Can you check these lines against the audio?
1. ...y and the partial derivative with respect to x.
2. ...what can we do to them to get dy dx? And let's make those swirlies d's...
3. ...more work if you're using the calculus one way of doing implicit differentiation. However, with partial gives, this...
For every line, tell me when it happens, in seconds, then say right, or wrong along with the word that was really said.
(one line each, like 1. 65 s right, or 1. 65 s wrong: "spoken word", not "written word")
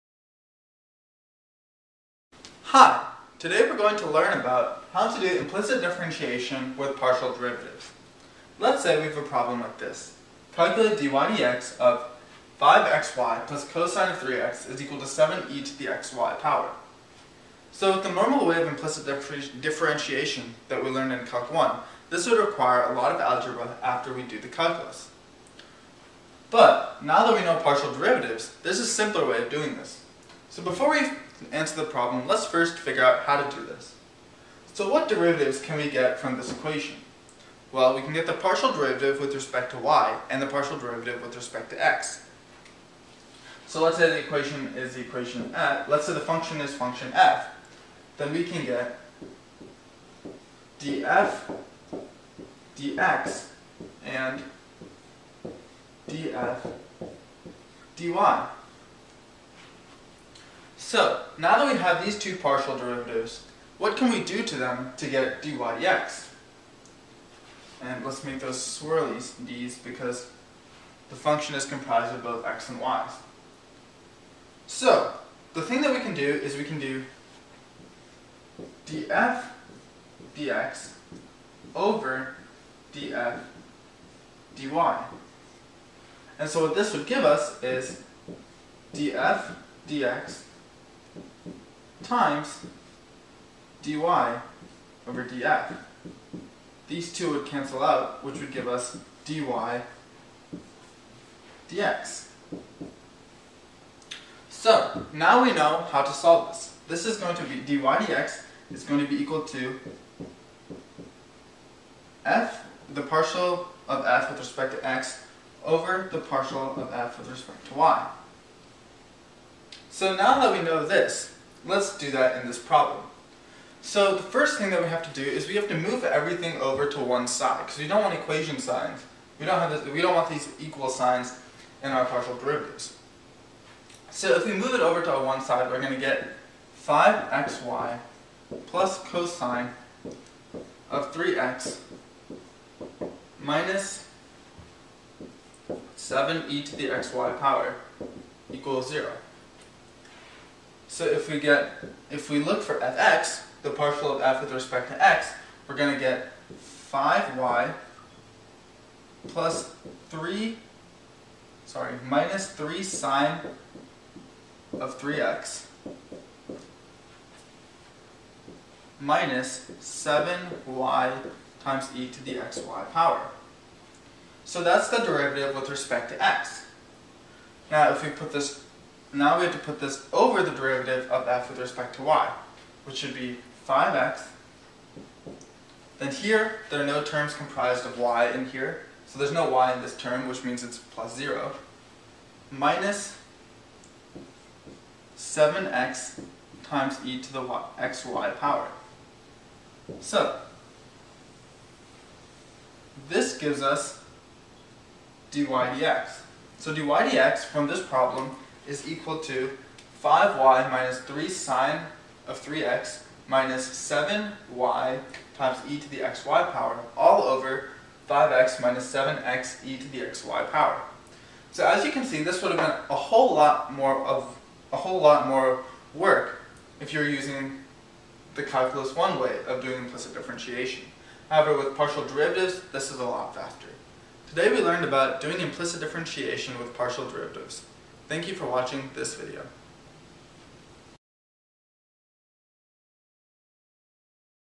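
1. 39 s right
2. 63 s right
3. 225 s wrong: "derivatives", not "gives".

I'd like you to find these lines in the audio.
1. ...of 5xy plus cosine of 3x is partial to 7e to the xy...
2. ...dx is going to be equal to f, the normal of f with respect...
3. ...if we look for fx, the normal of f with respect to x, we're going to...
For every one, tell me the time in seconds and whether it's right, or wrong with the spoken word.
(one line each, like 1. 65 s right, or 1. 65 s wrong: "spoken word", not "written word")
1. 11 s wrong: "equal", not "partial"
2. 107 s wrong: "partial", not "normal"
3. 152 s wrong: "partial", not "normal".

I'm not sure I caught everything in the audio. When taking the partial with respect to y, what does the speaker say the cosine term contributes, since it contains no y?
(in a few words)
0.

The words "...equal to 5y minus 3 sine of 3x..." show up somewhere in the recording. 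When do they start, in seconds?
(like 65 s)
208 s.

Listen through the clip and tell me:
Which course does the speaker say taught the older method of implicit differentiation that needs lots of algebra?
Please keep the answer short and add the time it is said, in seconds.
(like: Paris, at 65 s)
Calc 1, at 21 s.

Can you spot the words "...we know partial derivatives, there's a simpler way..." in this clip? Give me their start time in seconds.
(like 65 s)
27 s.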